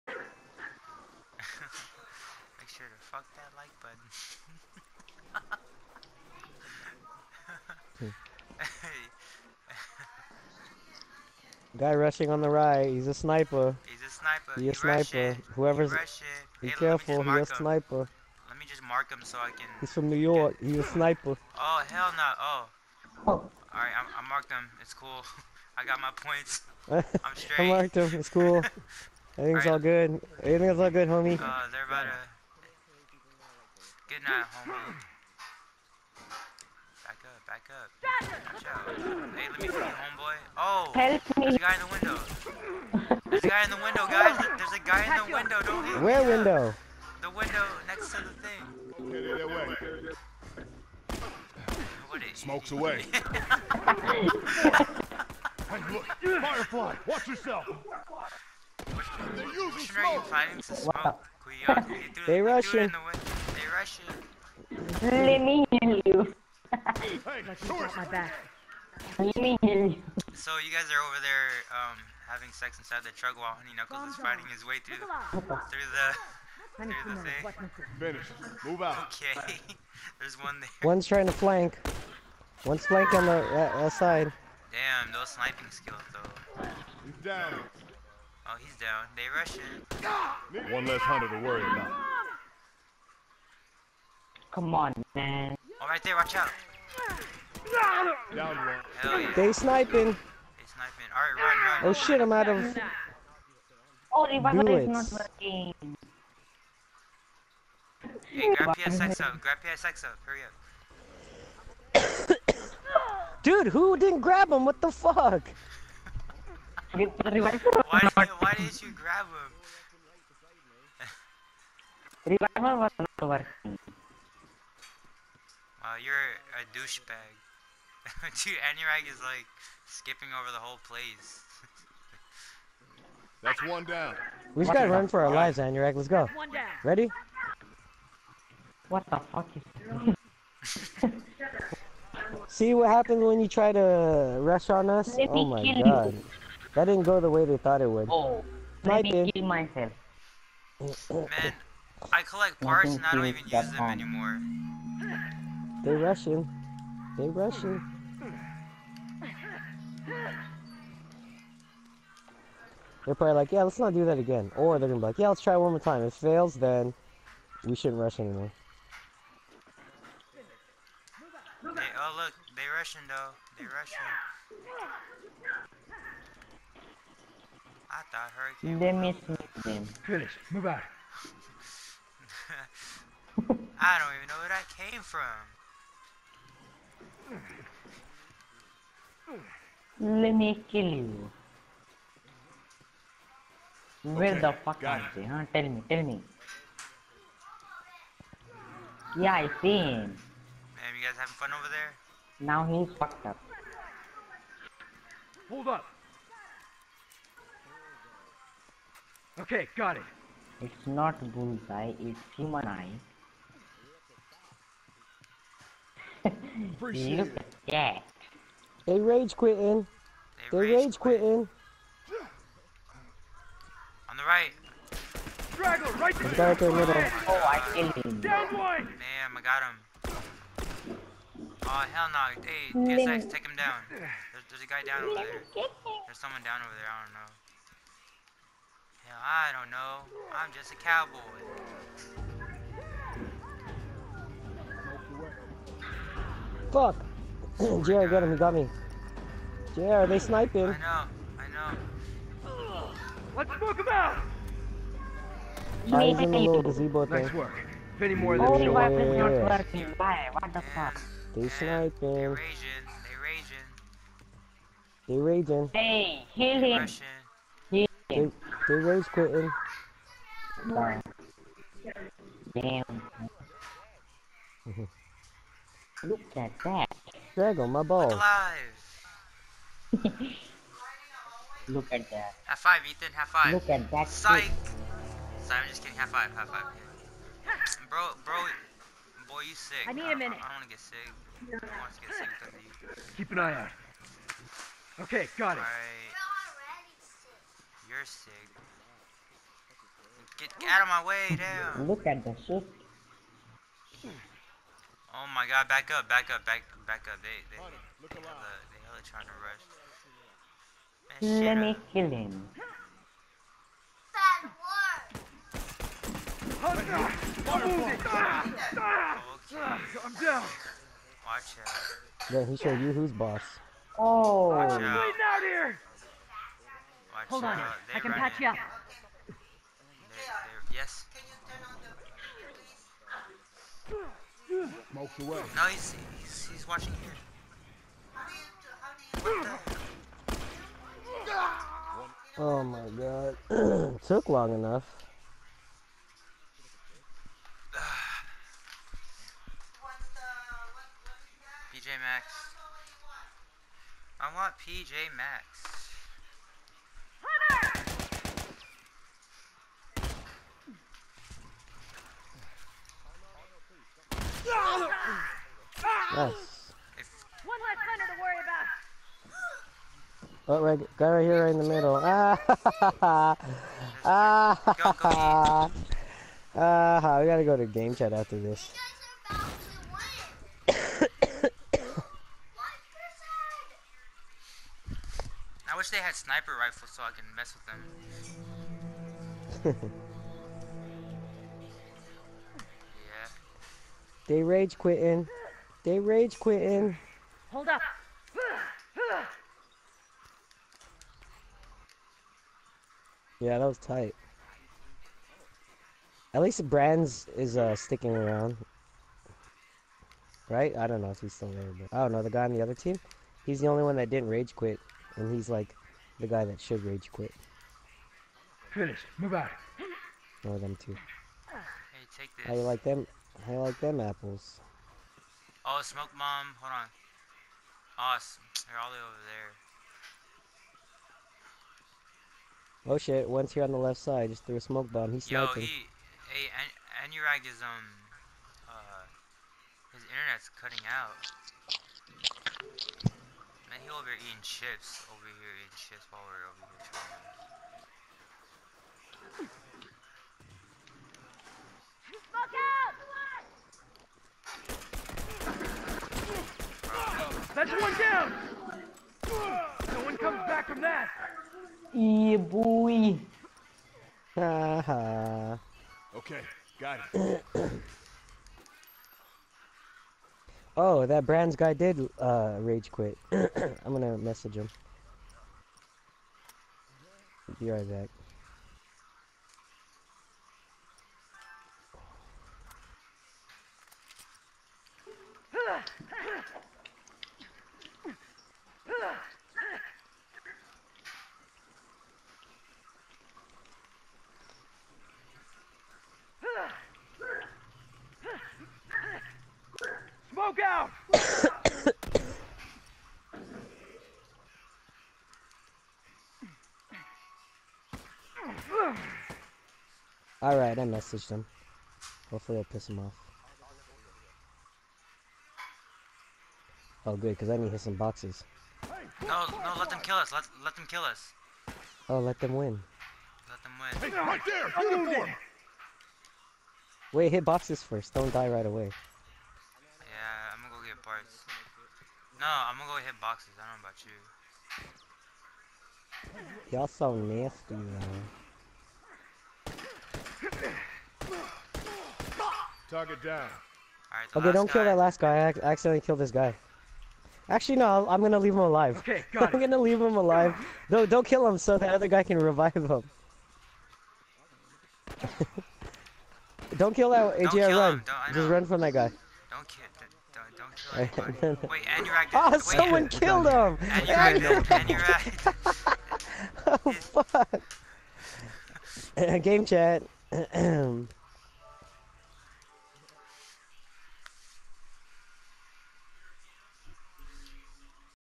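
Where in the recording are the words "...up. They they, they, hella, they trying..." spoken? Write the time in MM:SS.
05:07.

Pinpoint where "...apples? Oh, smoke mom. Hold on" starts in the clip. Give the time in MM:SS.
07:03.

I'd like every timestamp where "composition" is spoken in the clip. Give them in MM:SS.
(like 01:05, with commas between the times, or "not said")
not said.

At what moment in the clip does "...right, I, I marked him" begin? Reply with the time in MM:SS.
00:23.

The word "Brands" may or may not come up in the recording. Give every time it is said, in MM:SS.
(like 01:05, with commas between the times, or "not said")
06:46, 07:51.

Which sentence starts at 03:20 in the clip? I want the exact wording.
Man, you guys having fun over there?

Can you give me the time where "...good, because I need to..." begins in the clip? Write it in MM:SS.
08:37.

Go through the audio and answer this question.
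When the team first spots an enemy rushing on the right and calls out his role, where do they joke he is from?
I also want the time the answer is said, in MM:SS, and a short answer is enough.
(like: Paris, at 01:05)
New York, at 00:19.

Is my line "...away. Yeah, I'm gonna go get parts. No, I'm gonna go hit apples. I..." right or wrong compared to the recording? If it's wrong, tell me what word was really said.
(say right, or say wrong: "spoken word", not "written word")
wrong: "boxes", not "apples".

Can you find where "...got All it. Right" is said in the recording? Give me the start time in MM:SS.
04:55.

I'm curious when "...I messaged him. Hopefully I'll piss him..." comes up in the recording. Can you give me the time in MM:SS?
08:30.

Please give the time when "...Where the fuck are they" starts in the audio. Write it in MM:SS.
03:14.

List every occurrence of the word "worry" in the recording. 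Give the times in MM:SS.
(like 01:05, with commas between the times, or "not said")
01:31, 06:10.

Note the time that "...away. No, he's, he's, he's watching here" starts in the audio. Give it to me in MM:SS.
05:35.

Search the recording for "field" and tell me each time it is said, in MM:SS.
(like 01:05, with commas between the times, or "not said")
not said.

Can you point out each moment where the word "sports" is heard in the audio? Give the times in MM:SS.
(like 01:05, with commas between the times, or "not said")
not said.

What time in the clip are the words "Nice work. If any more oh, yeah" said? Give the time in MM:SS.
04:17.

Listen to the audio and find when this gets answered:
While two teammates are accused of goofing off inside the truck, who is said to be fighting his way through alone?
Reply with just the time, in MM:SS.
01:13.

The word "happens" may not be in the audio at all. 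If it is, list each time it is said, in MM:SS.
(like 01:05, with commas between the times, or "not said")
02:22.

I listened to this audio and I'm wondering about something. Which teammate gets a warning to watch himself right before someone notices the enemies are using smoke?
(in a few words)
Firefly.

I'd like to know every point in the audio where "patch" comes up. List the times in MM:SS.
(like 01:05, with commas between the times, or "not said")
05:28.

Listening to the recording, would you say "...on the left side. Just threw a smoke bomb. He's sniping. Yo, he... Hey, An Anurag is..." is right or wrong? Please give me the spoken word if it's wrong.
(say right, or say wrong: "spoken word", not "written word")
right.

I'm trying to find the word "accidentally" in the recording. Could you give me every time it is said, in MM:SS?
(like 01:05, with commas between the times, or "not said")
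09:05.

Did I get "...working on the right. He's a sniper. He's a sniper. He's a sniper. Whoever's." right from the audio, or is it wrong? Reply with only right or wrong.
wrong.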